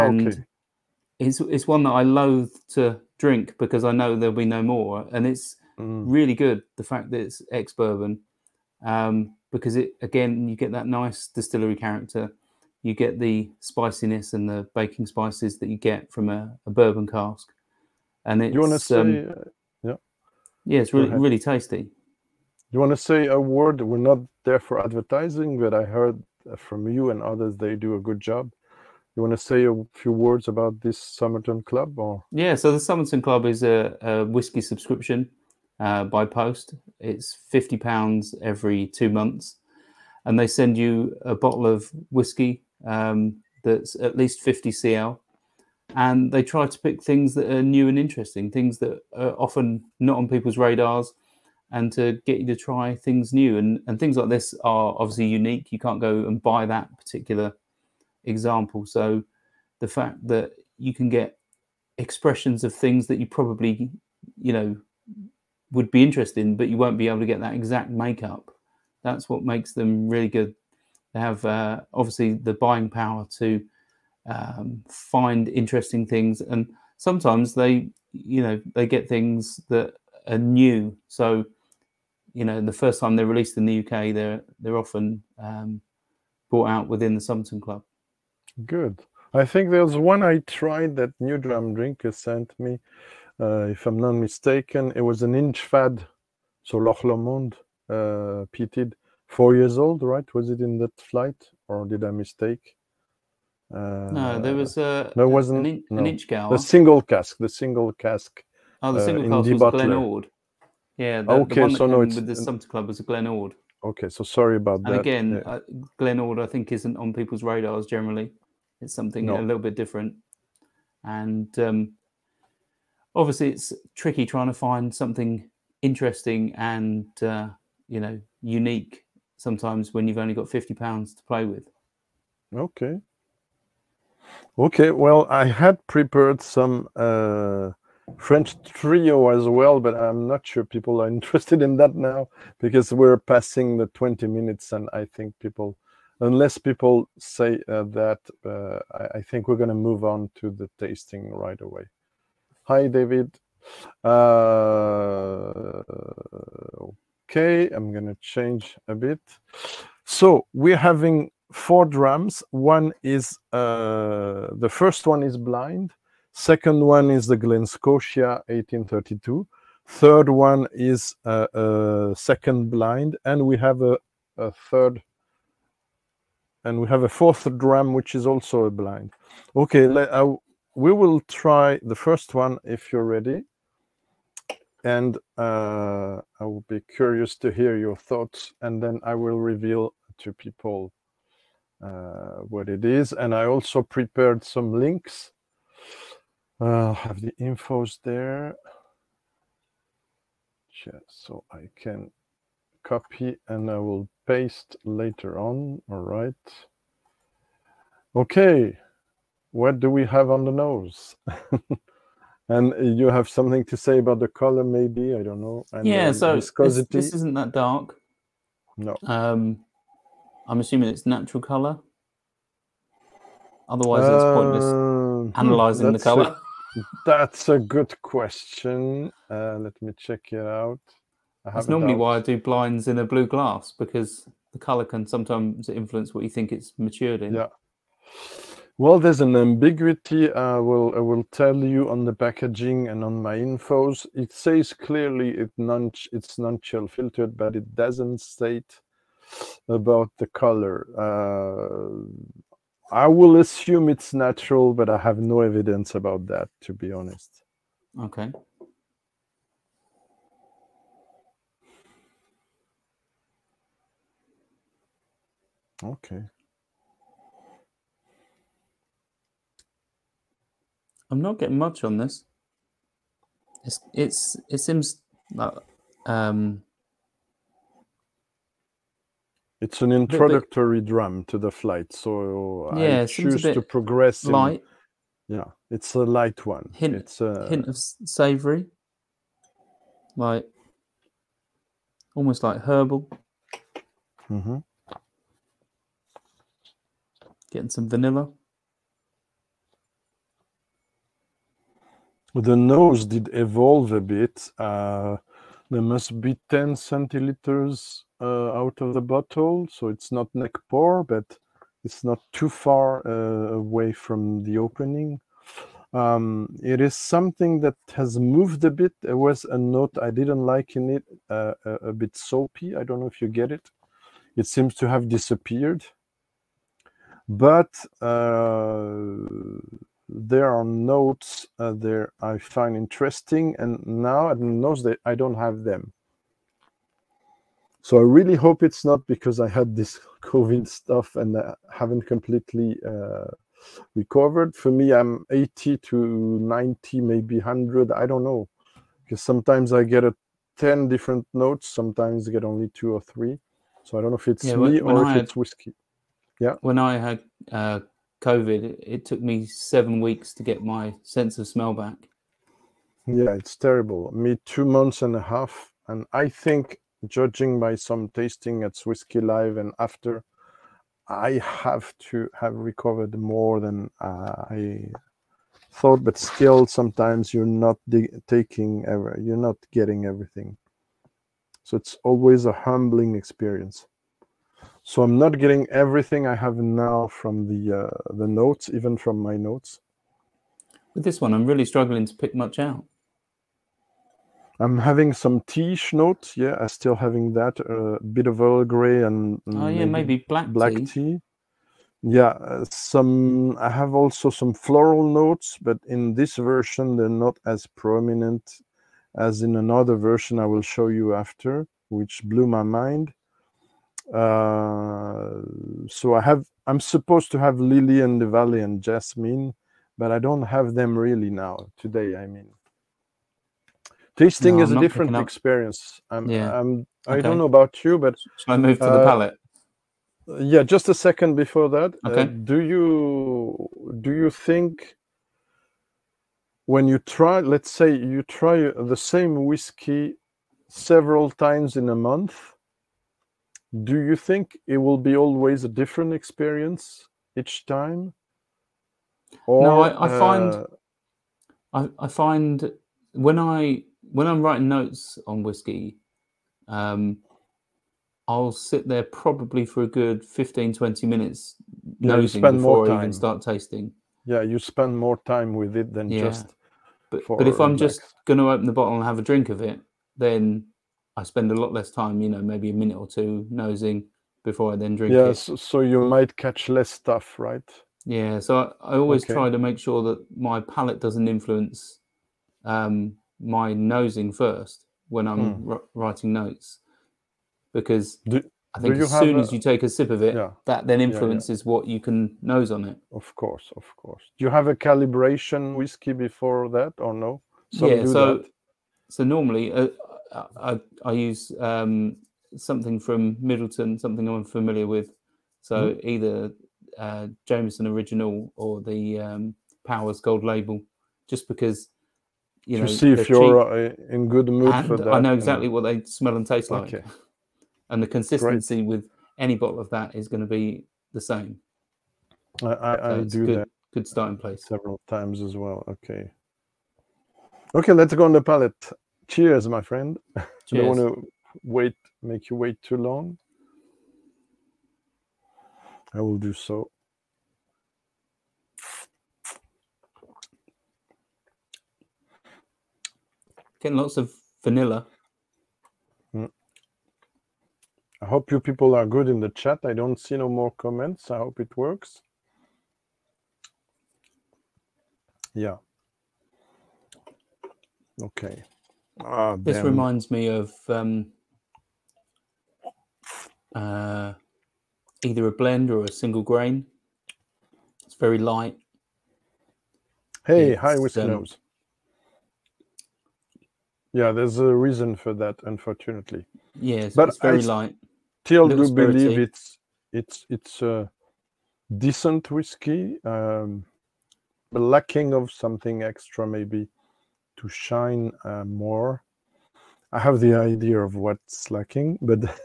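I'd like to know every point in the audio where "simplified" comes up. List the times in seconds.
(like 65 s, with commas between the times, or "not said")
not said.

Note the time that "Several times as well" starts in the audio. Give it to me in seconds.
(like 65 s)
524 s.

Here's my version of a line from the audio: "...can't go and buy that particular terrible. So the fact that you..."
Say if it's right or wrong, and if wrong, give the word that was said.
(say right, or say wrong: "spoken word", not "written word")
wrong: "example", not "terrible".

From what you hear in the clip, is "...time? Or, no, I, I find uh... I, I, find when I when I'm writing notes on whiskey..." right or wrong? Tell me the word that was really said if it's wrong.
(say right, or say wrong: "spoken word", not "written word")
right.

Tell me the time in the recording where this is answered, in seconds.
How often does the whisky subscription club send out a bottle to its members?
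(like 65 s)
38 s.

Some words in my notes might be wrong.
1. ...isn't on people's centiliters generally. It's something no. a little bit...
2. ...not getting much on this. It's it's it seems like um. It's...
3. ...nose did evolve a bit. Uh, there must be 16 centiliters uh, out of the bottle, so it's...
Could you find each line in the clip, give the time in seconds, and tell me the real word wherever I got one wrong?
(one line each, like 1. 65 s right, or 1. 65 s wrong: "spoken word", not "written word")
1. 116 s wrong: "radars", not "centiliters"
2. 271 s right
3. 302 s wrong: "10", not "16".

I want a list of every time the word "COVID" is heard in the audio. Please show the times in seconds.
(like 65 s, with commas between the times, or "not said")
340 s, 358 s.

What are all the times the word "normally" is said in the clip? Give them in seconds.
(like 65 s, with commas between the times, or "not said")
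231 s, 499 s.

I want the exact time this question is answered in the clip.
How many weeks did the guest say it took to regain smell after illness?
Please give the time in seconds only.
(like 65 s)
359 s.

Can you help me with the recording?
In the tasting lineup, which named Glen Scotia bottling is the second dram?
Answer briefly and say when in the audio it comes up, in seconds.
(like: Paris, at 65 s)
1832, at 168 s.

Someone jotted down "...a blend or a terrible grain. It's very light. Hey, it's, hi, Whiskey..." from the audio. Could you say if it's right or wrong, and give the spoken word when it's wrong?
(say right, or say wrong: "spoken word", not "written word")
wrong: "single", not "terrible".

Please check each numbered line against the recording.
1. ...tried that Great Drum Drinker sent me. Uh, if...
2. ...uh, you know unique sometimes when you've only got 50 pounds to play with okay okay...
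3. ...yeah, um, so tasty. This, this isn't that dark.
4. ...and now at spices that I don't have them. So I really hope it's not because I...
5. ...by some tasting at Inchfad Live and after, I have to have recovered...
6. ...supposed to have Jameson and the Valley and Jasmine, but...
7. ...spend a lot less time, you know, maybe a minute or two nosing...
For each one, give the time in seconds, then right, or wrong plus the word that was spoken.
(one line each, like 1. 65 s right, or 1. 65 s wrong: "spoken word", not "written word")
1. 90 s wrong: "New", not "Great"
2. 127 s right
3. 215 s wrong: "viscosity", not "tasty"
4. 333 s wrong: "notes", not "spices"
5. 367 s wrong: "Whiskey", not "Inchfad"
6. 416 s wrong: "Lily", not "Jameson"
7. 471 s right.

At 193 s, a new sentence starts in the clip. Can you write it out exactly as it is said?
And I also prepared some links.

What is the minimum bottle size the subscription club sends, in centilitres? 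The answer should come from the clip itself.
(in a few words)
50 cl.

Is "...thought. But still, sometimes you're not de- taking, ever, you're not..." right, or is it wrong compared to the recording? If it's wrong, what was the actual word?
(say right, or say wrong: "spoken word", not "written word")
right.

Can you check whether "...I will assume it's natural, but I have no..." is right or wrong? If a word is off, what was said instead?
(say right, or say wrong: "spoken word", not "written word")
right.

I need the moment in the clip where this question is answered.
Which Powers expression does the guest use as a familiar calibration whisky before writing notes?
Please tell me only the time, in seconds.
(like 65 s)
509 s.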